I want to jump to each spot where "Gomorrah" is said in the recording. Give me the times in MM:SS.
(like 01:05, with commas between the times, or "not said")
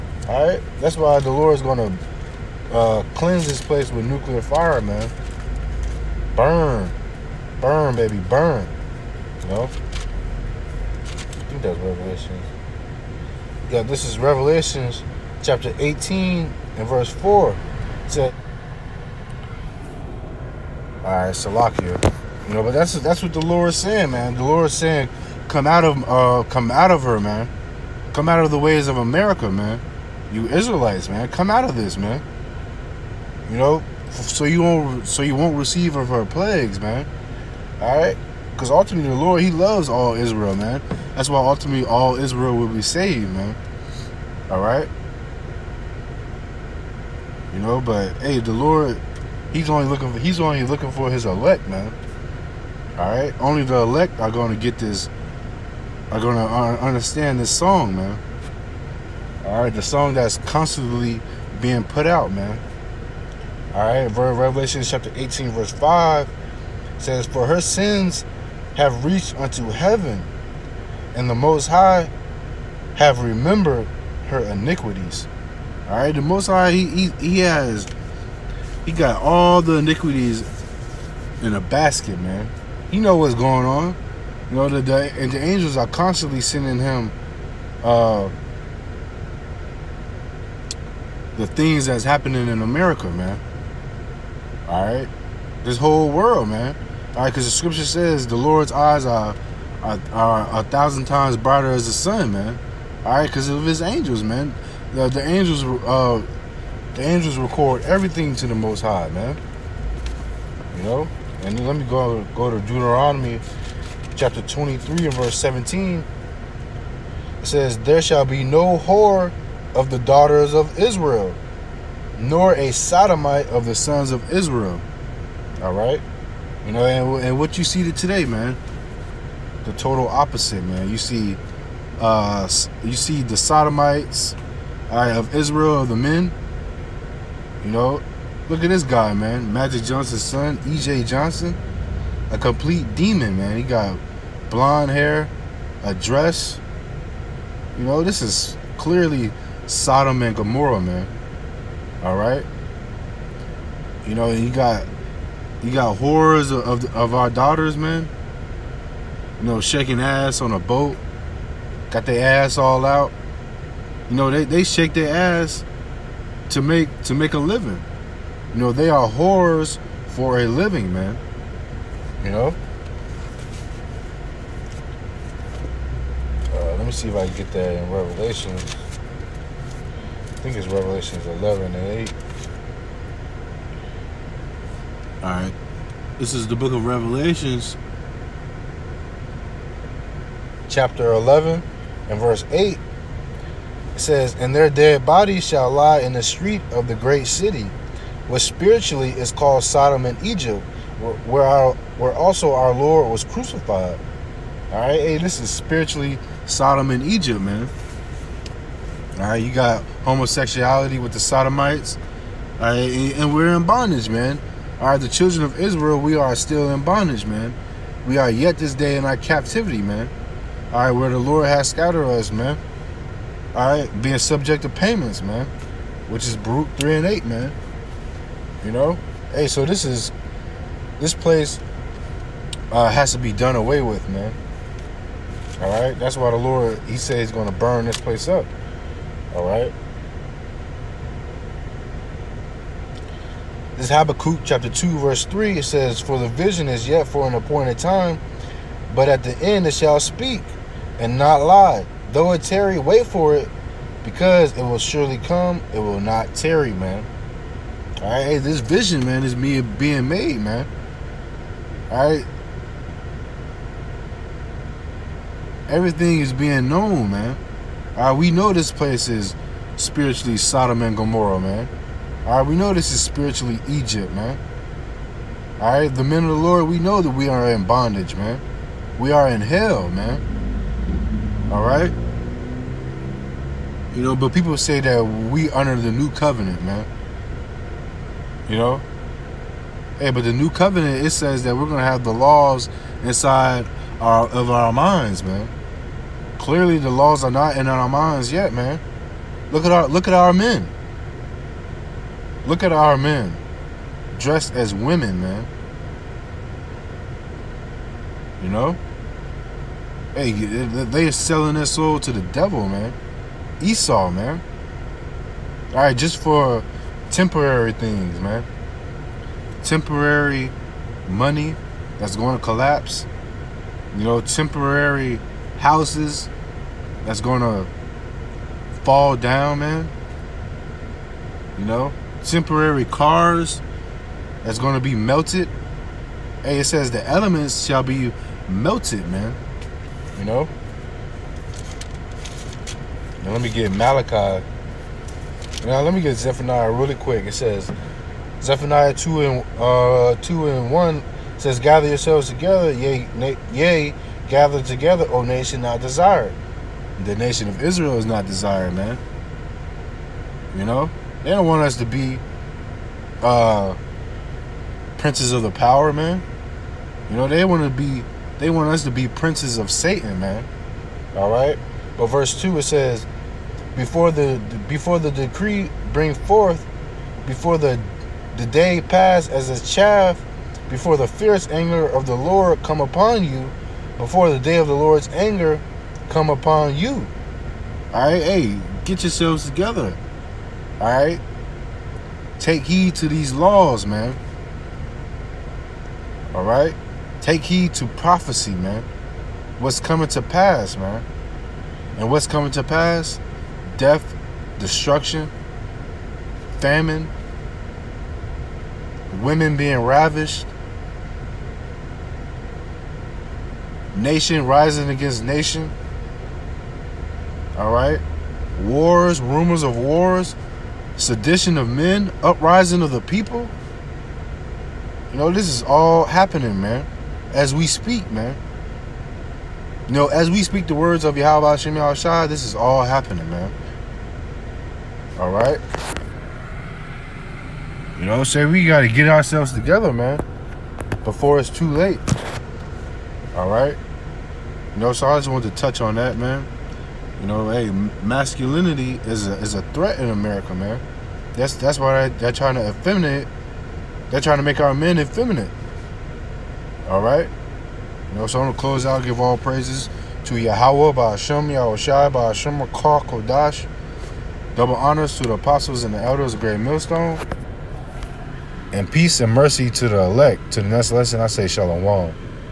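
02:30, 04:30.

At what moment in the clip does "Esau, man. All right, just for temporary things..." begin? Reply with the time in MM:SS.
05:13.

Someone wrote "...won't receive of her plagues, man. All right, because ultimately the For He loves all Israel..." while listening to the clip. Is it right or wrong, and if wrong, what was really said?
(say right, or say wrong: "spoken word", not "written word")
wrong: "Lord", not "For".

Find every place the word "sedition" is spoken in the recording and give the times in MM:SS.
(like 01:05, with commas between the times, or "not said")
07:00.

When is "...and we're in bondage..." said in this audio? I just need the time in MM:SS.
03:33.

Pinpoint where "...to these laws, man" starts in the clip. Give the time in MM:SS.
06:32.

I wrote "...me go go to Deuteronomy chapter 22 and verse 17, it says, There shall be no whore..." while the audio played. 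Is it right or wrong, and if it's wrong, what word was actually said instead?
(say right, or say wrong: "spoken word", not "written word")
wrong: "23", not "22".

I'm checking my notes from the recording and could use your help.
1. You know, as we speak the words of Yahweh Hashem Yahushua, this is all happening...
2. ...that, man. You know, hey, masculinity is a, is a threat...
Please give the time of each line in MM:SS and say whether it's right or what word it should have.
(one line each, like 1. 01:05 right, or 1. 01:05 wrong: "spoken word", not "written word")
1. 07:09 right
2. 07:25 right.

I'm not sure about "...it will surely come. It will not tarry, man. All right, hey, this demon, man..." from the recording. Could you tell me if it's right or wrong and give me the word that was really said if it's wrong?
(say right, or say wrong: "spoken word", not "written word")
wrong: "vision", not "demon".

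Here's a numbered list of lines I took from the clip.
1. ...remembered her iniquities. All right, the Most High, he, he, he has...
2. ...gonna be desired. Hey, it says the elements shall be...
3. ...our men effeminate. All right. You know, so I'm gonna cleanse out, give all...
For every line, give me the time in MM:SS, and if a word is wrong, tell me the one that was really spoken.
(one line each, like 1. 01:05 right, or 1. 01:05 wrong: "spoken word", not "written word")
1. 01:13 right
2. 05:34 wrong: "melted", not "desired"
3. 07:34 wrong: "close", not "cleanse".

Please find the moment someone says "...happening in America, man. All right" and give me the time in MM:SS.
01:32.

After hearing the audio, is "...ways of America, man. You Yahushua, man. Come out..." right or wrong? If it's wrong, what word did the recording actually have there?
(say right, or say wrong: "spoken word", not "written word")
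wrong: "Israelites", not "Yahushua".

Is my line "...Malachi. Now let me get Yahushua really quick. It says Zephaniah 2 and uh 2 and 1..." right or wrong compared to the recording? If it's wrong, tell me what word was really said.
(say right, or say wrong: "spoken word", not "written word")
wrong: "Zephaniah", not "Yahushua".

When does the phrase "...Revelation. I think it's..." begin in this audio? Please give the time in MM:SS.
02:57.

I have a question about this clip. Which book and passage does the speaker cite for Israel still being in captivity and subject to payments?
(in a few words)
Baruch 3:8.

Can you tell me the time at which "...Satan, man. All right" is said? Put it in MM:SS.
06:09.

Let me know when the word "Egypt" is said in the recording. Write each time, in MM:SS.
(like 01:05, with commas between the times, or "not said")
03:20, 03:27, 04:33.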